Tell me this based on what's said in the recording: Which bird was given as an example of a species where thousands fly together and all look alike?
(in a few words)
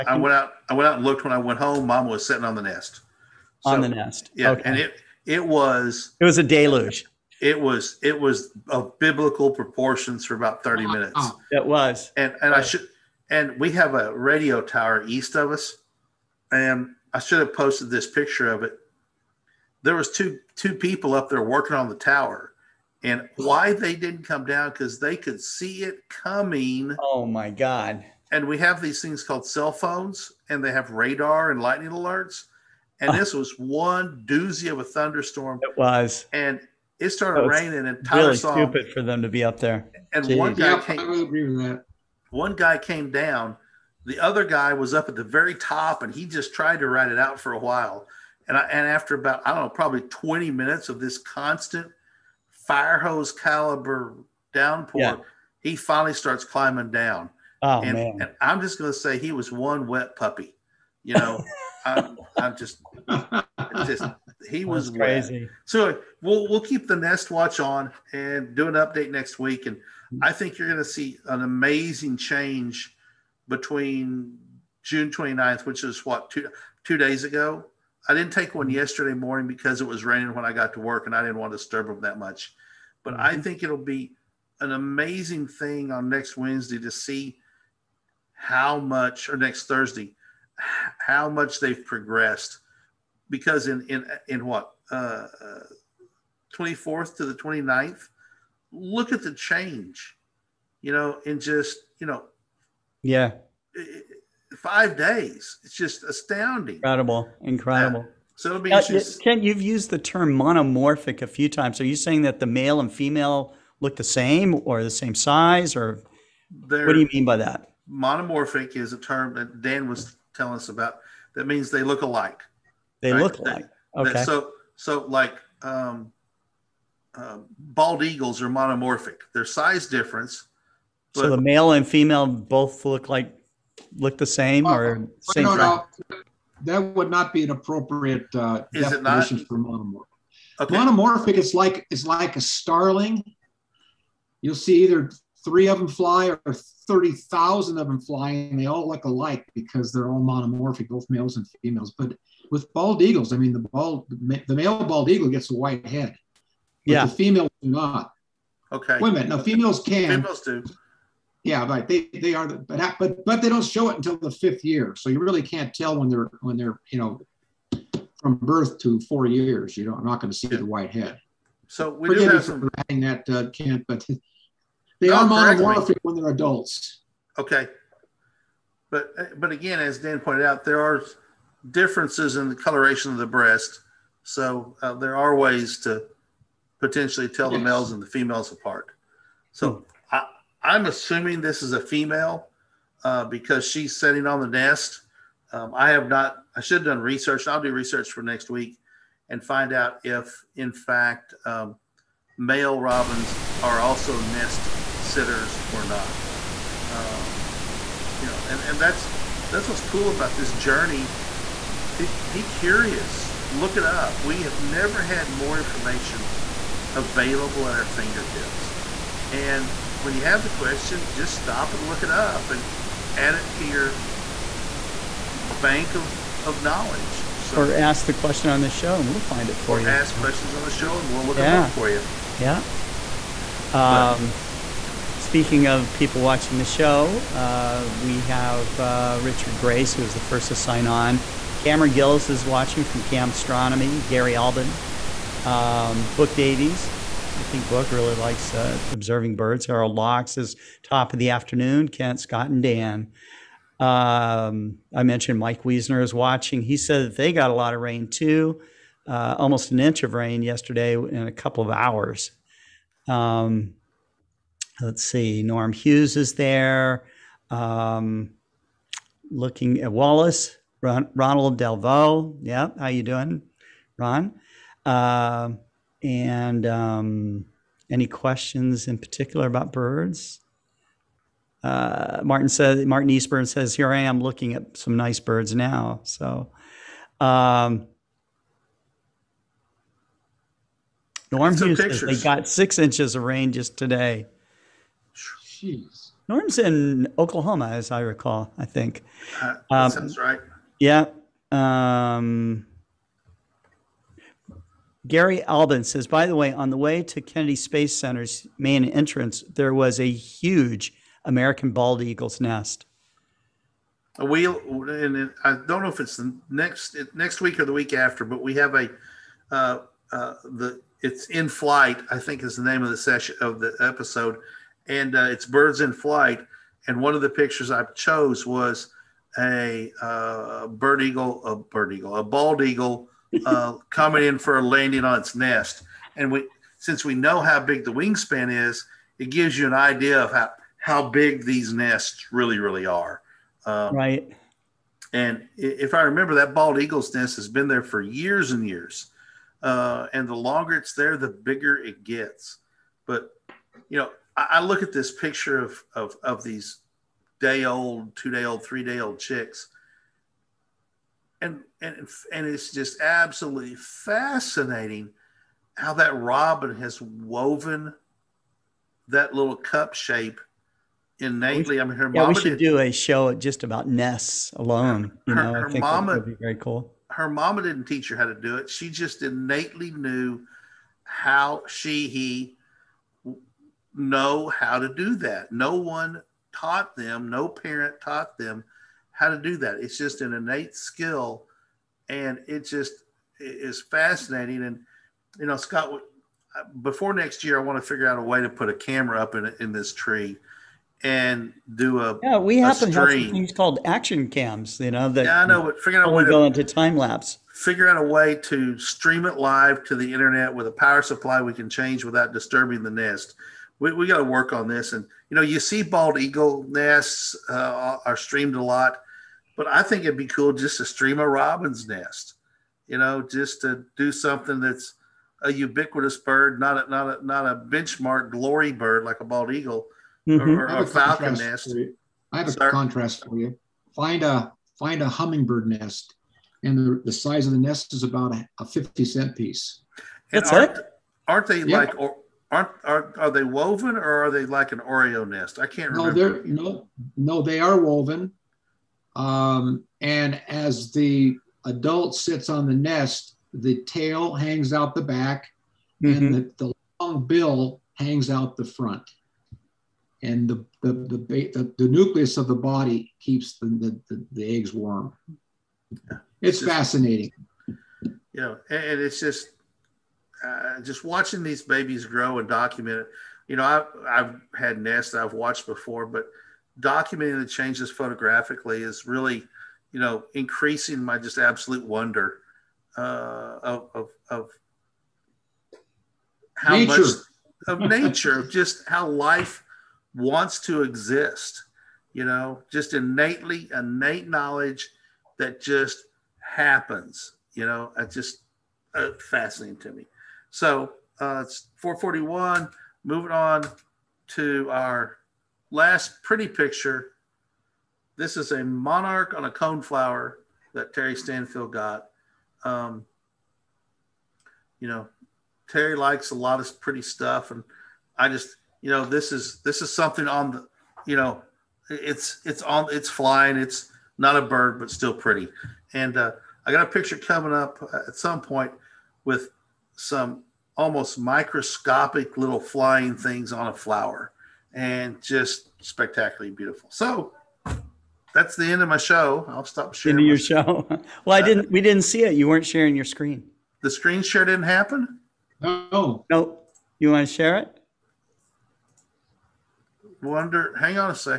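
starling.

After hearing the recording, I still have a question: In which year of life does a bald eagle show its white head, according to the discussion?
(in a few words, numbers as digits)
5th year.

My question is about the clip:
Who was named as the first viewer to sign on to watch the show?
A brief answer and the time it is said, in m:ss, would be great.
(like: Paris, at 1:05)
Richard Grace, at 3:59.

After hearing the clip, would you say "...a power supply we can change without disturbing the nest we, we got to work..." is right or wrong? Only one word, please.
right.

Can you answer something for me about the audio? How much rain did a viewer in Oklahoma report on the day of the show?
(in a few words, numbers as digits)
6 inches.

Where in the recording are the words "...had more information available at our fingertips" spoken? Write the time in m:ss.
3:35.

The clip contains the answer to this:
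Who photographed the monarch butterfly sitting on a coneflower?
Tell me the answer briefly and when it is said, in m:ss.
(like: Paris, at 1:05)
Terry Stanfield, at 8:30.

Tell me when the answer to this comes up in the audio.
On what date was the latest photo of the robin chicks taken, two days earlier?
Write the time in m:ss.
1:14.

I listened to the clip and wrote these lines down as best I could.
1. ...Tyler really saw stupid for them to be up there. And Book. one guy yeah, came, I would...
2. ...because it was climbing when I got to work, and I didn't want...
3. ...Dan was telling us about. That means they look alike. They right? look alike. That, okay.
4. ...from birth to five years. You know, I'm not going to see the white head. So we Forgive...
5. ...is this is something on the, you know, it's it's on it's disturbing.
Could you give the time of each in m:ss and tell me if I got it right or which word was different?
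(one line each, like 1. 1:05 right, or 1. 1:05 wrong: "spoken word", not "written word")
1. 0:38 wrong: "Jeez", not "Book"
2. 1:19 wrong: "raining", not "climbing"
3. 1:59 right
4. 2:48 wrong: "four", not "five"
5. 8:39 wrong: "flying", not "disturbing".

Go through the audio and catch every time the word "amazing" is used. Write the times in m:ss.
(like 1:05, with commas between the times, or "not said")
1:11, 1:24.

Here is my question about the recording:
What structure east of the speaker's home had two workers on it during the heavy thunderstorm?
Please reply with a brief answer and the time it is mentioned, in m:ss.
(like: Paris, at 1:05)
radio tower, at 0:14.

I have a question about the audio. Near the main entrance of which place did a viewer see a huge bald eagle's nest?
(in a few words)
Kennedy Space Center.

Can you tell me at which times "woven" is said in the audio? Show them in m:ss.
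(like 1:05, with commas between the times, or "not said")
6:07, 7:23, 7:27.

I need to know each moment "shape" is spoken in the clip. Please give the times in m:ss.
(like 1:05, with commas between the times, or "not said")
6:09.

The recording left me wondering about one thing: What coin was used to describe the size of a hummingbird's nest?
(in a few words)
50 cent piece.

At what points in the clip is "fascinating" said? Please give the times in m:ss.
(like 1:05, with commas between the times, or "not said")
6:03, 6:33, 7:46, 8:19.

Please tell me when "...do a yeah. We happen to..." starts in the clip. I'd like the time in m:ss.
6:41.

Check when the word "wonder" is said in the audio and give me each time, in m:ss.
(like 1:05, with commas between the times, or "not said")
8:01, 9:10.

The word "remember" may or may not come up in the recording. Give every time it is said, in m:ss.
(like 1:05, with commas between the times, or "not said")
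5:46, 7:26.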